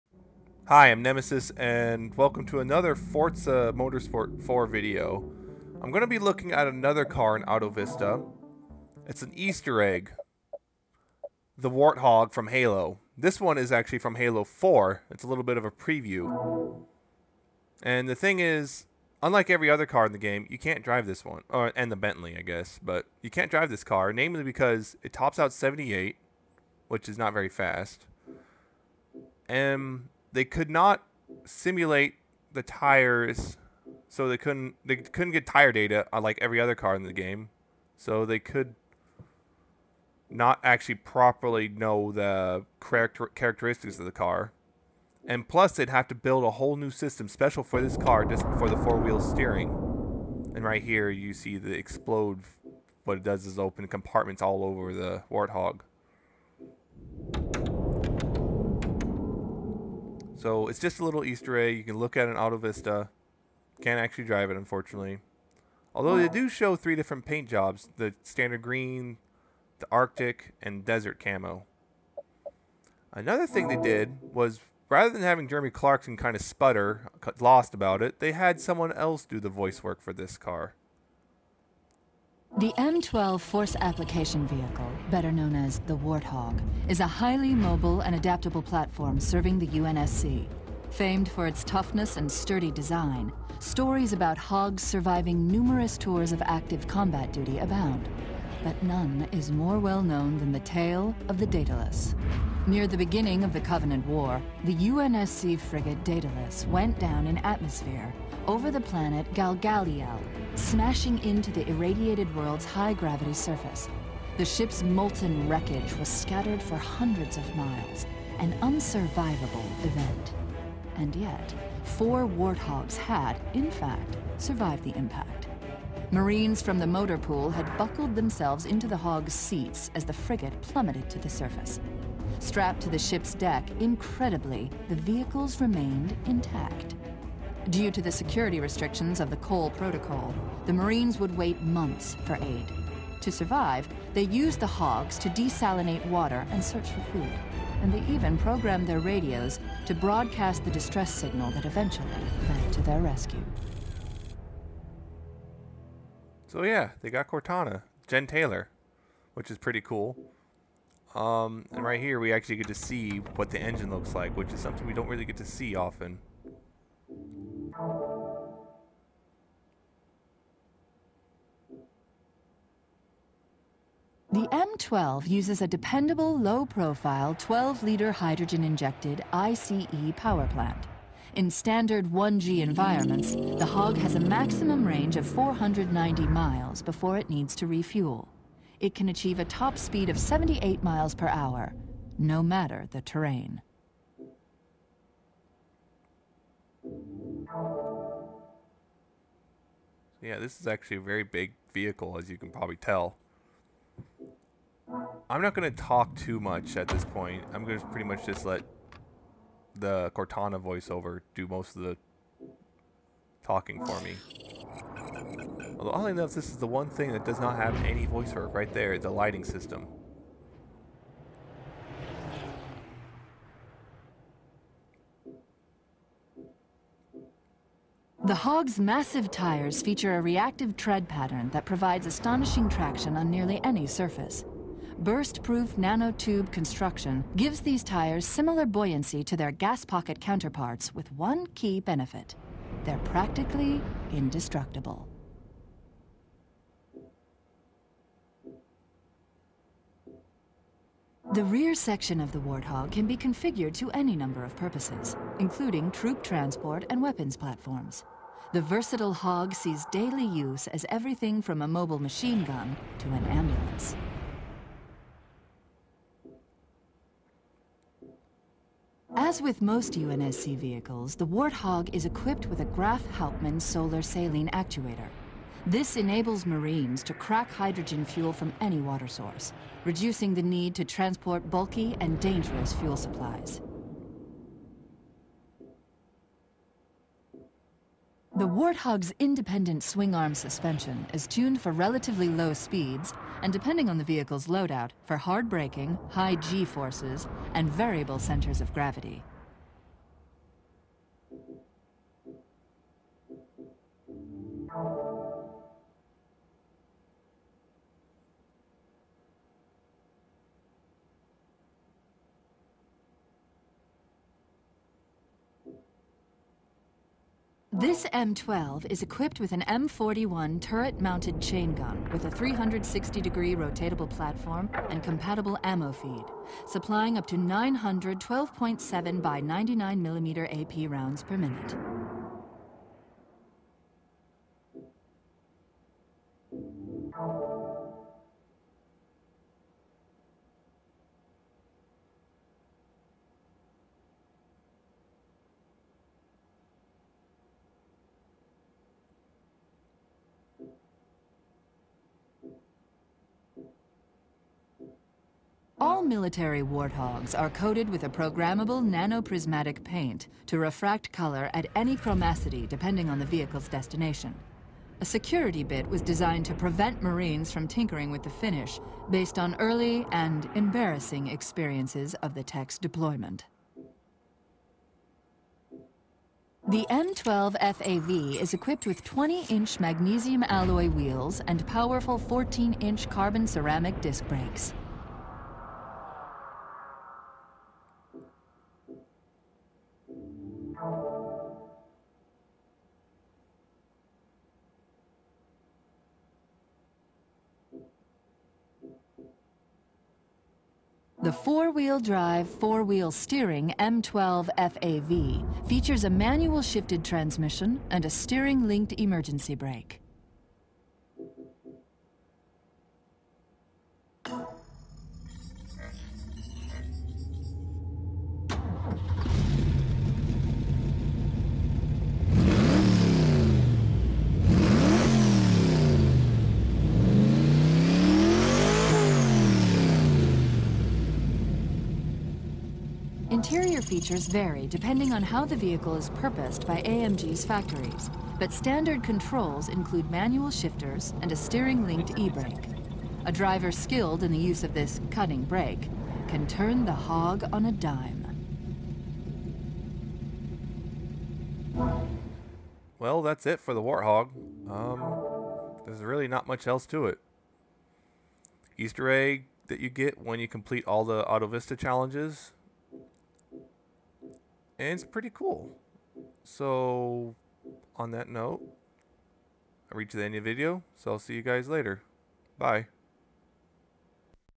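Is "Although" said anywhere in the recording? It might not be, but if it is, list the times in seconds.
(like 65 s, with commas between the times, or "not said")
65 s, 215 s.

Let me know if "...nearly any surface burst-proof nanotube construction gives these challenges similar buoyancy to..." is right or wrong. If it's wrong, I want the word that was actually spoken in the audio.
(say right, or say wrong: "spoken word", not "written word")
wrong: "tires", not "challenges".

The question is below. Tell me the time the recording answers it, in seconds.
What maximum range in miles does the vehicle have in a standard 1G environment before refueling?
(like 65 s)
185 s.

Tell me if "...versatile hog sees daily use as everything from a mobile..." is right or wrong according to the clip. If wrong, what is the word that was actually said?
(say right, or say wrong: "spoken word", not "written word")
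right.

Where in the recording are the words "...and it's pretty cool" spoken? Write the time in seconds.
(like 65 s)
464 s.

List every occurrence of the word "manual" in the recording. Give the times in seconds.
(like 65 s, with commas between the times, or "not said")
406 s, 440 s.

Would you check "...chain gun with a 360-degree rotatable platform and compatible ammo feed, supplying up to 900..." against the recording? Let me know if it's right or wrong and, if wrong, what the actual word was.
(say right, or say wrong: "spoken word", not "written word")
right.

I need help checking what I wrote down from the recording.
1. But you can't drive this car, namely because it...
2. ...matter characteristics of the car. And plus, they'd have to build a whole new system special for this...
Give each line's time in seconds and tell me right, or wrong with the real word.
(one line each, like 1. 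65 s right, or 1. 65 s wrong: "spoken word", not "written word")
1. 22 s right
2. 42 s wrong: "character", not "matter".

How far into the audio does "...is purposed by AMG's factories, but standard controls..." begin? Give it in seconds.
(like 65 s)
435 s.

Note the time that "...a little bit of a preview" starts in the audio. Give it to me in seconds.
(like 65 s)
15 s.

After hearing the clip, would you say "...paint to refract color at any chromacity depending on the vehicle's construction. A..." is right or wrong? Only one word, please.
wrong.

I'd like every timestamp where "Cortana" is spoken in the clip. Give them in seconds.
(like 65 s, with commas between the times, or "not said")
157 s, 210 s.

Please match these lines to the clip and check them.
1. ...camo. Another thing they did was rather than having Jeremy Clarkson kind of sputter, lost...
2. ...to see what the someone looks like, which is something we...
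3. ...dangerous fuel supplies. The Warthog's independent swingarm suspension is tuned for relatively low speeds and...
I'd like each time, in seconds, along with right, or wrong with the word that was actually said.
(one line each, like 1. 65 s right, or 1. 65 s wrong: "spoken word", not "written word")
1. 71 s right
2. 162 s wrong: "engine", not "someone"
3. 282 s right.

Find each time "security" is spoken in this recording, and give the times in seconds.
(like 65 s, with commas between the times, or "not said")
138 s, 365 s.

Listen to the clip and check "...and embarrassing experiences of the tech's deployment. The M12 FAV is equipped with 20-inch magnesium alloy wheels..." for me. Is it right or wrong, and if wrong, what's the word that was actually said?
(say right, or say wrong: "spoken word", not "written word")
right.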